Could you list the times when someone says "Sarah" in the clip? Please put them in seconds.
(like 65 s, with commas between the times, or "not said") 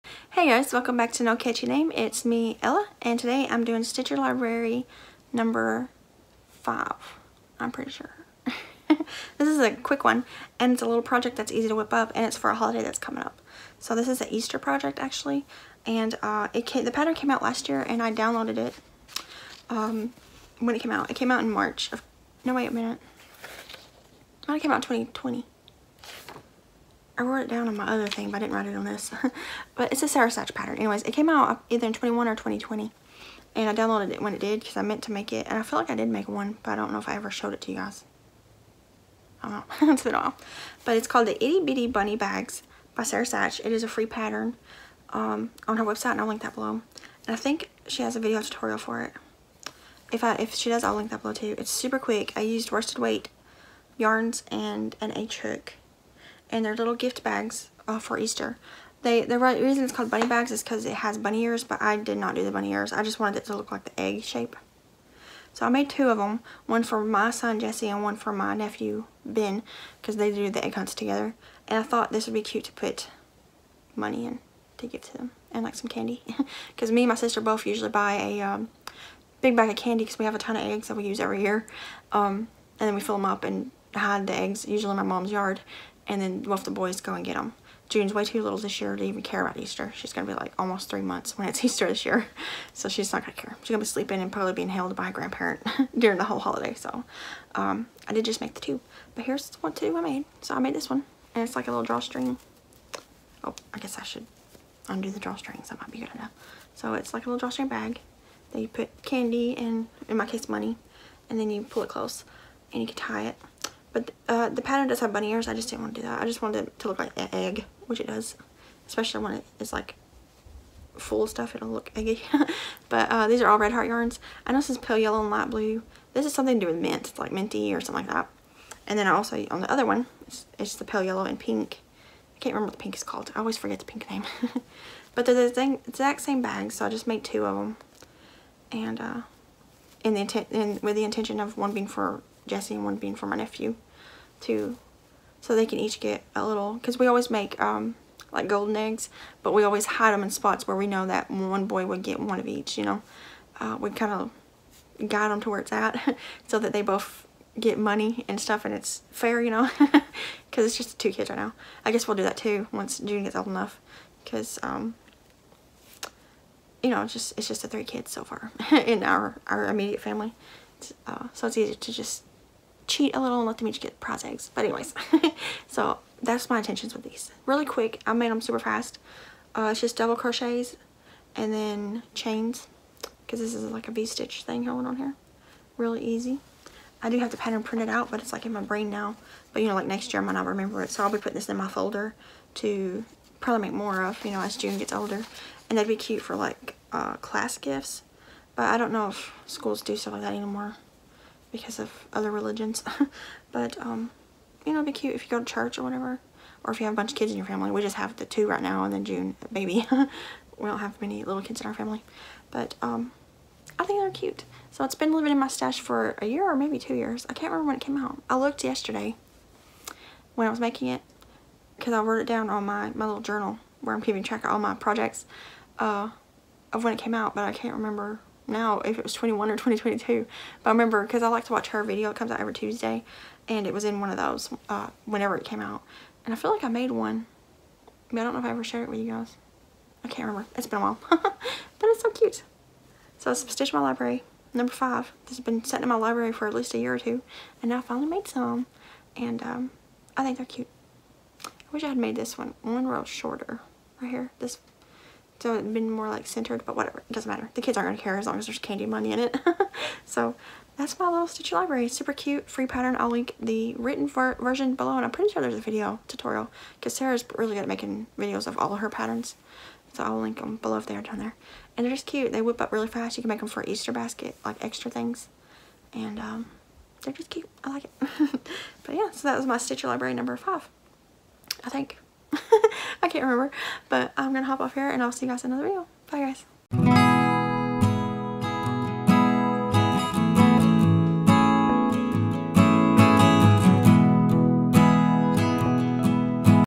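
30 s, 43 s, 266 s.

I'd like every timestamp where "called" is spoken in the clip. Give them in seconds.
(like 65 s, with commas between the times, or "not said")
41 s, 59 s, 133 s.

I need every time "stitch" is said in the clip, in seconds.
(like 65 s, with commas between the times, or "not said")
3 s, 183 s, 243 s, 261 s, 279 s.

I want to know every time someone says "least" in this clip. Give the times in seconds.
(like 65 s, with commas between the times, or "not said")
246 s.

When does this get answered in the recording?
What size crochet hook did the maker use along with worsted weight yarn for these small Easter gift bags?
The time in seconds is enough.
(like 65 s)
54 s.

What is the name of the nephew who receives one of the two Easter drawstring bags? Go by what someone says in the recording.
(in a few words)
Ben.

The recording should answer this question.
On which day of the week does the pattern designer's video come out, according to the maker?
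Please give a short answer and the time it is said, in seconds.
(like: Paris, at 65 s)
Tuesday, at 232 s.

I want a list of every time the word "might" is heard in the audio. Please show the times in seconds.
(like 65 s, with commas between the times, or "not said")
105 s, 190 s.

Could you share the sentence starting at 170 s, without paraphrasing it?
It's, uh, so it's easy to just cheat a little and let them each get prize eggs.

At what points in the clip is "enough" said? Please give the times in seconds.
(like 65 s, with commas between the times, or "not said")
106 s, 163 s.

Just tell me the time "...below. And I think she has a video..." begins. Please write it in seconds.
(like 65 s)
46 s.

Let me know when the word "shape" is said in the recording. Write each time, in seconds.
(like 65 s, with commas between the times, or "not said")
64 s.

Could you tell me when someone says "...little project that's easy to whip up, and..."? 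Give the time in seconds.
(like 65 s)
10 s.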